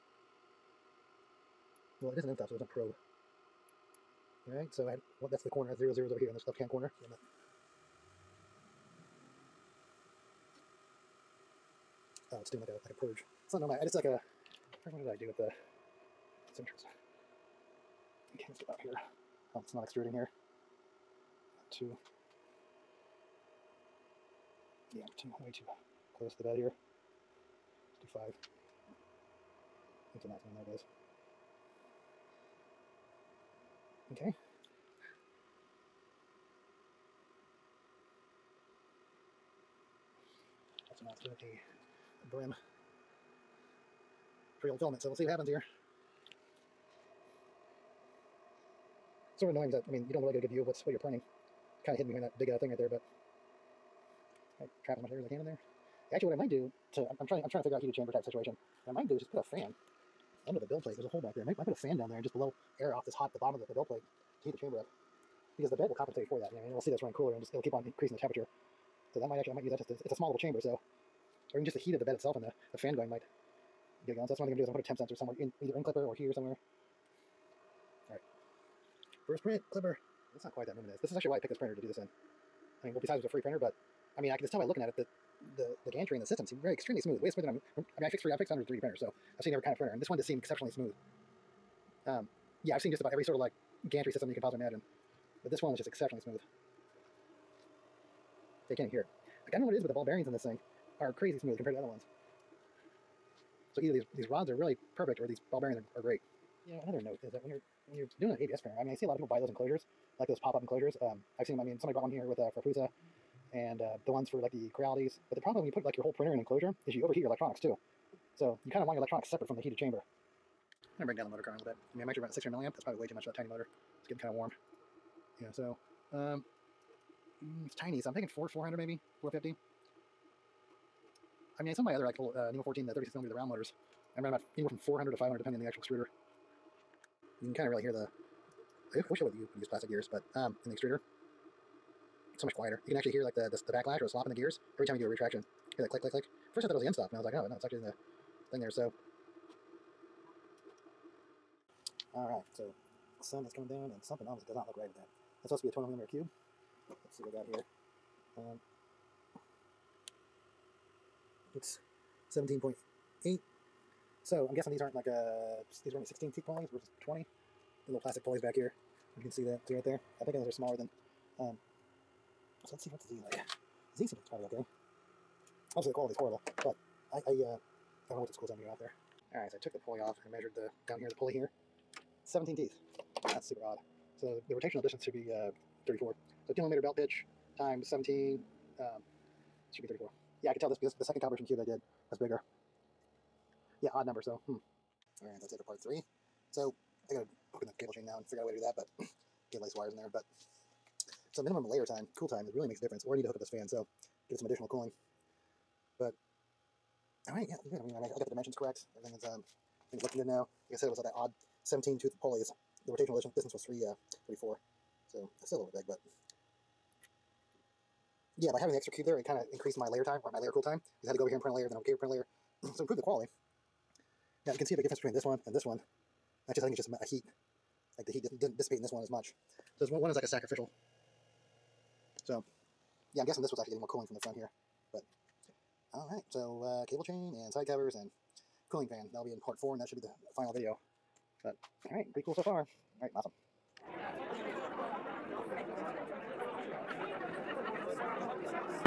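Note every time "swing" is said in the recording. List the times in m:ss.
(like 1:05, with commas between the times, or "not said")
not said.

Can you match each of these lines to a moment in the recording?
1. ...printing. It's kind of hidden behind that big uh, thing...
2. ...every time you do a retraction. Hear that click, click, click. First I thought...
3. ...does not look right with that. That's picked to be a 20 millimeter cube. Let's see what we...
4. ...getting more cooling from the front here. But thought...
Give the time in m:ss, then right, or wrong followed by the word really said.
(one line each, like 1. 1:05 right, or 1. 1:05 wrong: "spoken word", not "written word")
1. 0:50 right
2. 2:24 right
3. 2:34 wrong: "supposed", not "picked"
4. 3:53 wrong: "alright", not "thought".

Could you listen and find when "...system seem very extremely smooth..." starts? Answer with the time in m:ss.
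1:26.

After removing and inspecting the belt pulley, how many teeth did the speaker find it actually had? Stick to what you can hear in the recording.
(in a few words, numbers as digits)
17.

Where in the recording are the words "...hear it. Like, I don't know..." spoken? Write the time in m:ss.
1:38.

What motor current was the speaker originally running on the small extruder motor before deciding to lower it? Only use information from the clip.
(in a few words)
600 milliamps.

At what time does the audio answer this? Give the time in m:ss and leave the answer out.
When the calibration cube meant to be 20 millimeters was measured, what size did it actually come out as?
2:42.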